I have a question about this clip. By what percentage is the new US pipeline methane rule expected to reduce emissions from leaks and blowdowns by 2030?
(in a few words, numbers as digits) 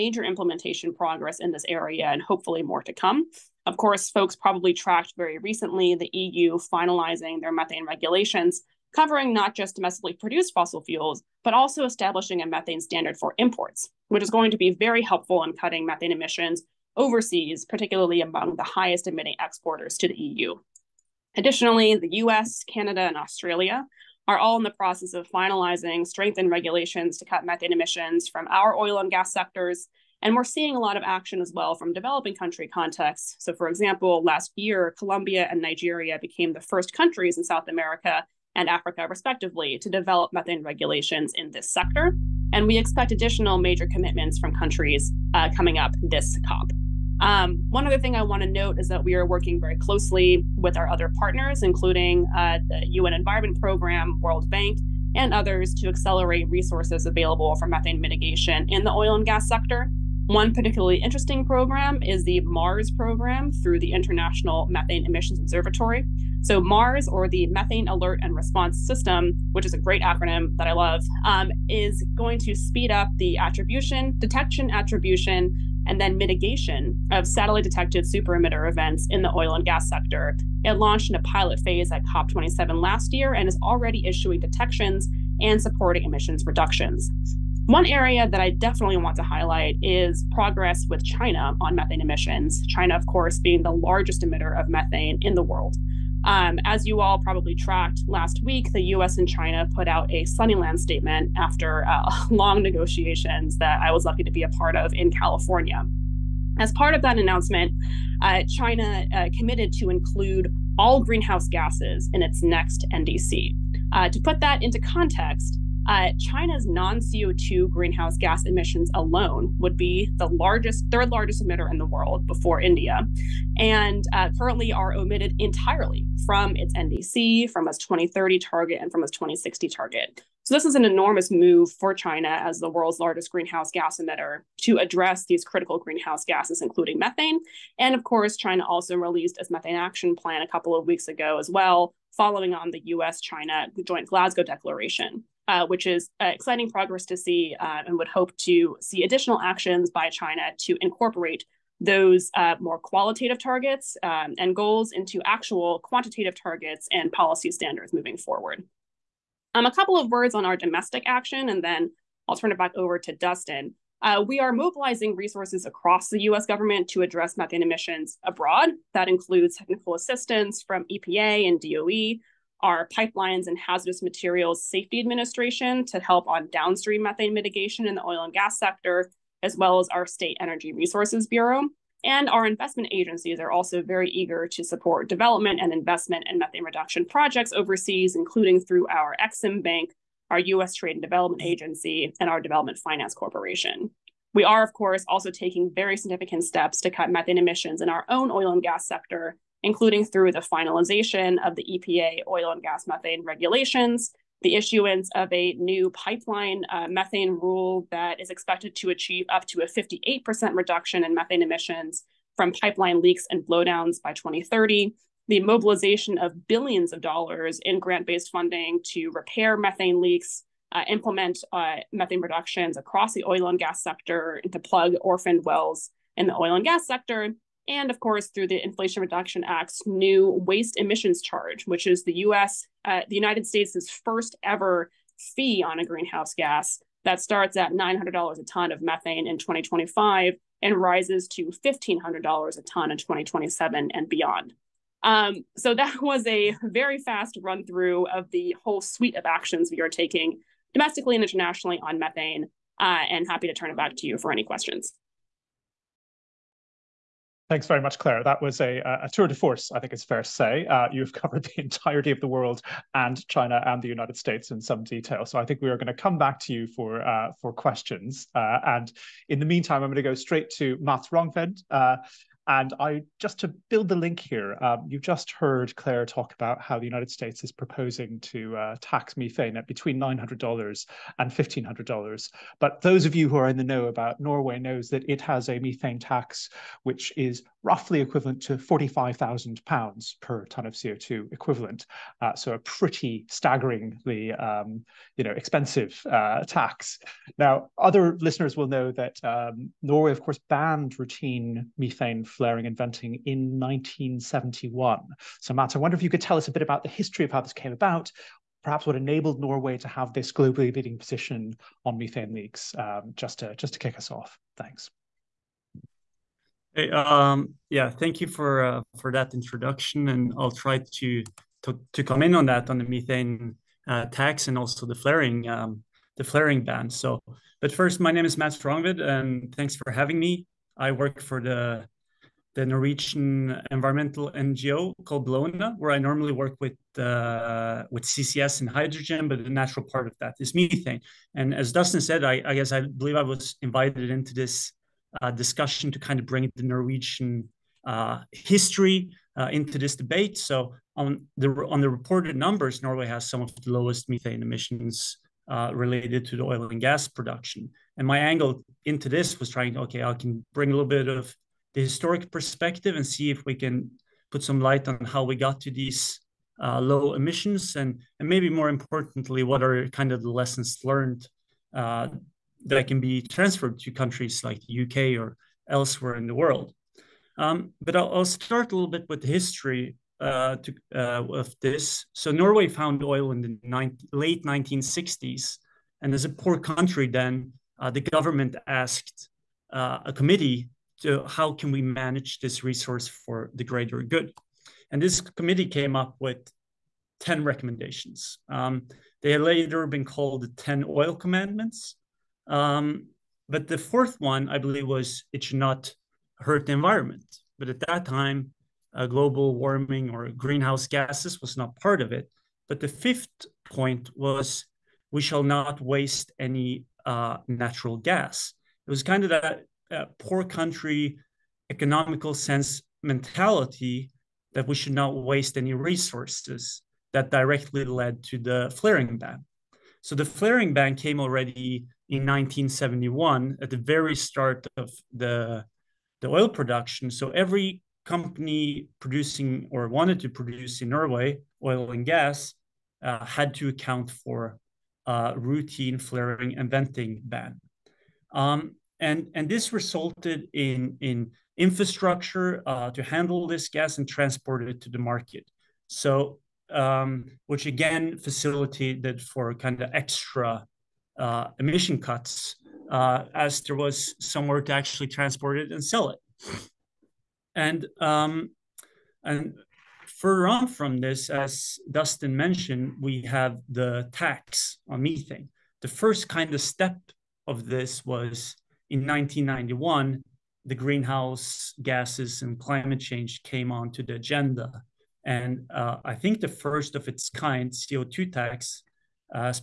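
58%.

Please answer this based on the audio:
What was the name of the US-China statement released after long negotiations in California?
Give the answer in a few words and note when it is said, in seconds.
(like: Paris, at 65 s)
Sunnyland statement, at 100 s.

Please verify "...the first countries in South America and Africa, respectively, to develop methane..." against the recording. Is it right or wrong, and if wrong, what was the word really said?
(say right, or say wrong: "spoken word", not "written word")
right.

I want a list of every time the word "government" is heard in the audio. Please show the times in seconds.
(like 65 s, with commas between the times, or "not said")
166 s, 388 s.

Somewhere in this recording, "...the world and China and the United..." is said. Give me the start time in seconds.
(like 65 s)
262 s.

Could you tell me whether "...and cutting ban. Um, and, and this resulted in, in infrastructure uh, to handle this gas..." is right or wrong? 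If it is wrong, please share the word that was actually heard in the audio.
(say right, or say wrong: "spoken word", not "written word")
wrong: "venting", not "cutting".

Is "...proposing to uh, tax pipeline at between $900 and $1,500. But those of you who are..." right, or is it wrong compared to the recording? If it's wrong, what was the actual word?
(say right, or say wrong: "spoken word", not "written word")
wrong: "methane", not "pipeline".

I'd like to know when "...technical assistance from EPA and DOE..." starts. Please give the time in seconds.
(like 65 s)
169 s.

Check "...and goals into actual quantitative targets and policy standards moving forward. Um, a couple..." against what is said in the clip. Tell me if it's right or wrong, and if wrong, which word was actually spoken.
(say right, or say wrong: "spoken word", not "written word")
right.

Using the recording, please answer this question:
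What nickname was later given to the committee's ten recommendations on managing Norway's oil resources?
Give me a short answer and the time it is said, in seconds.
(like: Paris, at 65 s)
the 10 oil commandments, at 400 s.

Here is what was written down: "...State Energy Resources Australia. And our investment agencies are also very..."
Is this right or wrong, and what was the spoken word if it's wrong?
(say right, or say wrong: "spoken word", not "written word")
wrong: "Bureau", not "Australia".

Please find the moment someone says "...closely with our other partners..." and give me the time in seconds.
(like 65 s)
49 s.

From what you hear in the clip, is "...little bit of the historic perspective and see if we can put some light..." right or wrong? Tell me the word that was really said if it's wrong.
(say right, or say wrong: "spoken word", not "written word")
right.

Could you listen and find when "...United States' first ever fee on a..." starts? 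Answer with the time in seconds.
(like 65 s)
233 s.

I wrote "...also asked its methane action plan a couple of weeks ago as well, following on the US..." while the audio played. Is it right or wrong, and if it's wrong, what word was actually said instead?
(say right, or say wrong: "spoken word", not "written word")
wrong: "released", not "asked".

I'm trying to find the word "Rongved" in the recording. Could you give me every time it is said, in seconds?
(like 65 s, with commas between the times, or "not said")
271 s, 328 s.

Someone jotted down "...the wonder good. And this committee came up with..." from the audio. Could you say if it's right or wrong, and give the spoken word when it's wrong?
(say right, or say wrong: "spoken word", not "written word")
wrong: "greater", not "wonder".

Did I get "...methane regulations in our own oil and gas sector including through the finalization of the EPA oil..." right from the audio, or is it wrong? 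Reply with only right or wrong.
wrong.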